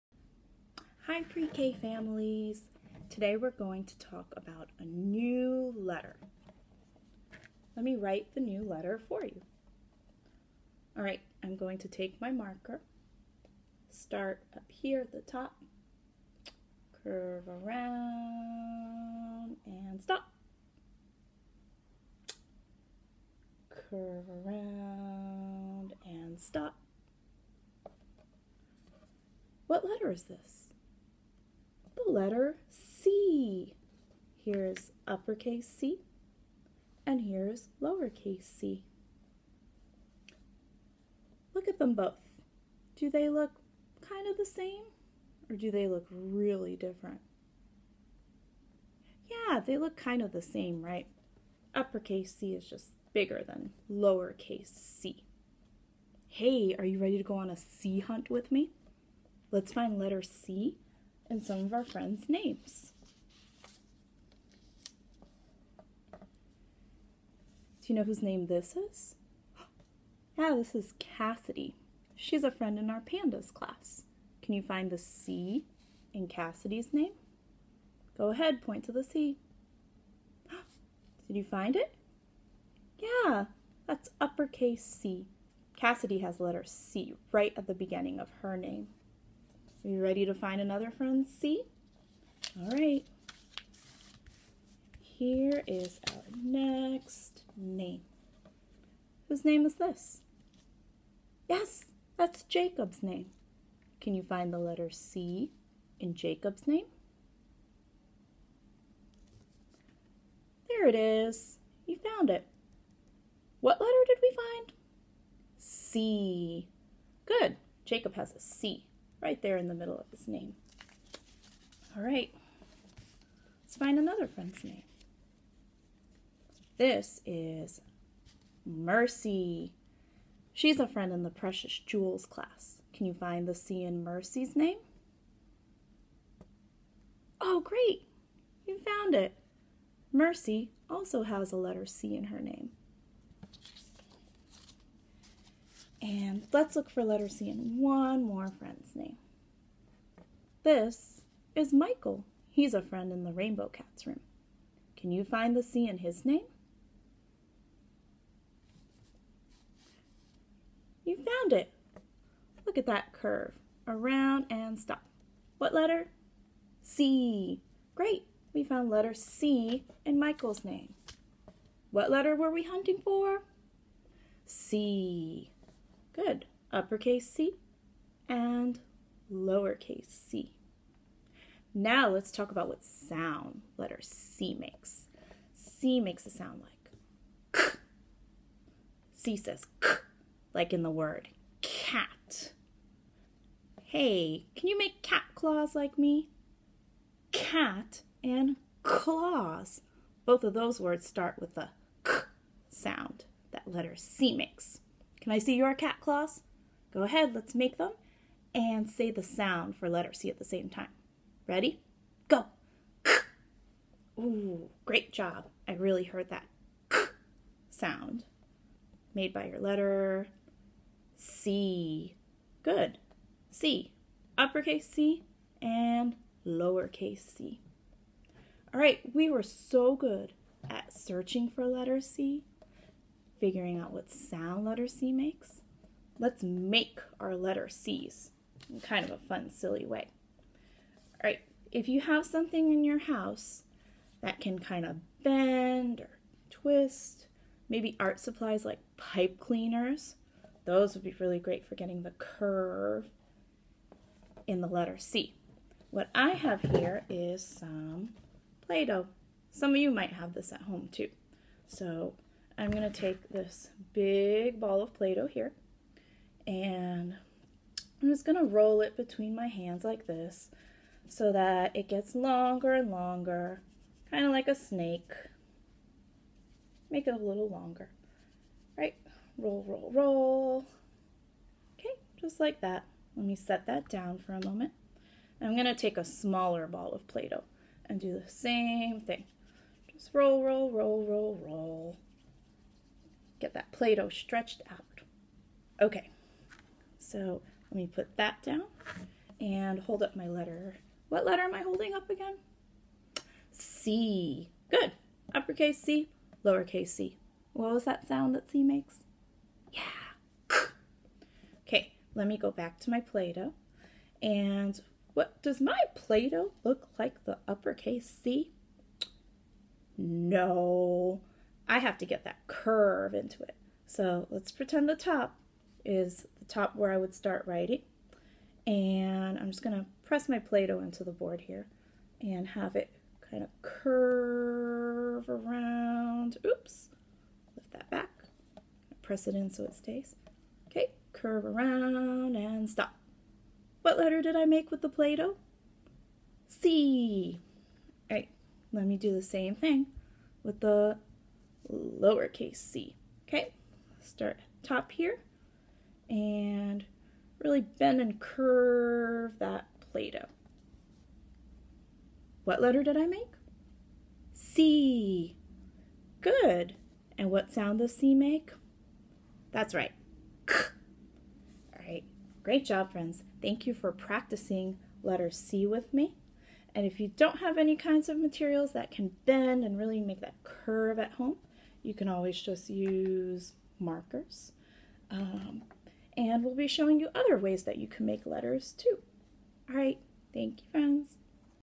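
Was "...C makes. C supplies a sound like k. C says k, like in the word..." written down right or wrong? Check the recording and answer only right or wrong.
wrong.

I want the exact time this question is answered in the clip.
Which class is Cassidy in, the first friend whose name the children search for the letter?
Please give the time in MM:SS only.
01:13.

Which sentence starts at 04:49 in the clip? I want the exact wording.
Just roll, roll, roll, roll, roll.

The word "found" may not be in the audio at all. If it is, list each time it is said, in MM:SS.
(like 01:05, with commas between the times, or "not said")
01:51, 02:18, 02:41, 02:48.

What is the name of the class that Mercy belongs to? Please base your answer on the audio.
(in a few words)
Precious Jewels.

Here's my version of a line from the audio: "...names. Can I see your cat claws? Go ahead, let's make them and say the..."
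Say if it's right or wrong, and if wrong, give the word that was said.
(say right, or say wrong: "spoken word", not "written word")
wrong: "makes", not "names".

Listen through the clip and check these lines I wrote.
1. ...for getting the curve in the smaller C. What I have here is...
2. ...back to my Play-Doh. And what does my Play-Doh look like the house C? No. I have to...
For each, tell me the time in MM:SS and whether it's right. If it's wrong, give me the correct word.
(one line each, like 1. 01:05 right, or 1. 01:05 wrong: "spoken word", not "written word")
1. 04:11 wrong: "letter", not "smaller"
2. 05:12 wrong: "uppercase", not "house".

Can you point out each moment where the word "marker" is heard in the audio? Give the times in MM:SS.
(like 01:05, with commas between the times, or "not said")
00:12, 06:23.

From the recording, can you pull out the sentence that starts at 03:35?
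I really heard that sound made by your letter C.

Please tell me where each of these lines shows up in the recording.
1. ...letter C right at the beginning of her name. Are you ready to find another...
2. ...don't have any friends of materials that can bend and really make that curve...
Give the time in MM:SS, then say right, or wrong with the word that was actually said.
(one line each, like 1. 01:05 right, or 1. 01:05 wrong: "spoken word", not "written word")
1. 01:26 right
2. 06:17 wrong: "kinds", not "friends".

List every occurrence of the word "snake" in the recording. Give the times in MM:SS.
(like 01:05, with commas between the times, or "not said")
04:34.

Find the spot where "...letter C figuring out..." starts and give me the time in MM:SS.
03:51.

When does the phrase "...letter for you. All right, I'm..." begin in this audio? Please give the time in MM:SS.
00:08.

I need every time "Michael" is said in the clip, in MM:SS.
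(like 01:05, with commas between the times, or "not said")
02:31, 02:50.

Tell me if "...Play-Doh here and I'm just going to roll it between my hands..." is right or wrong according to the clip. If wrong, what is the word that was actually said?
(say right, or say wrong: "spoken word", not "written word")
right.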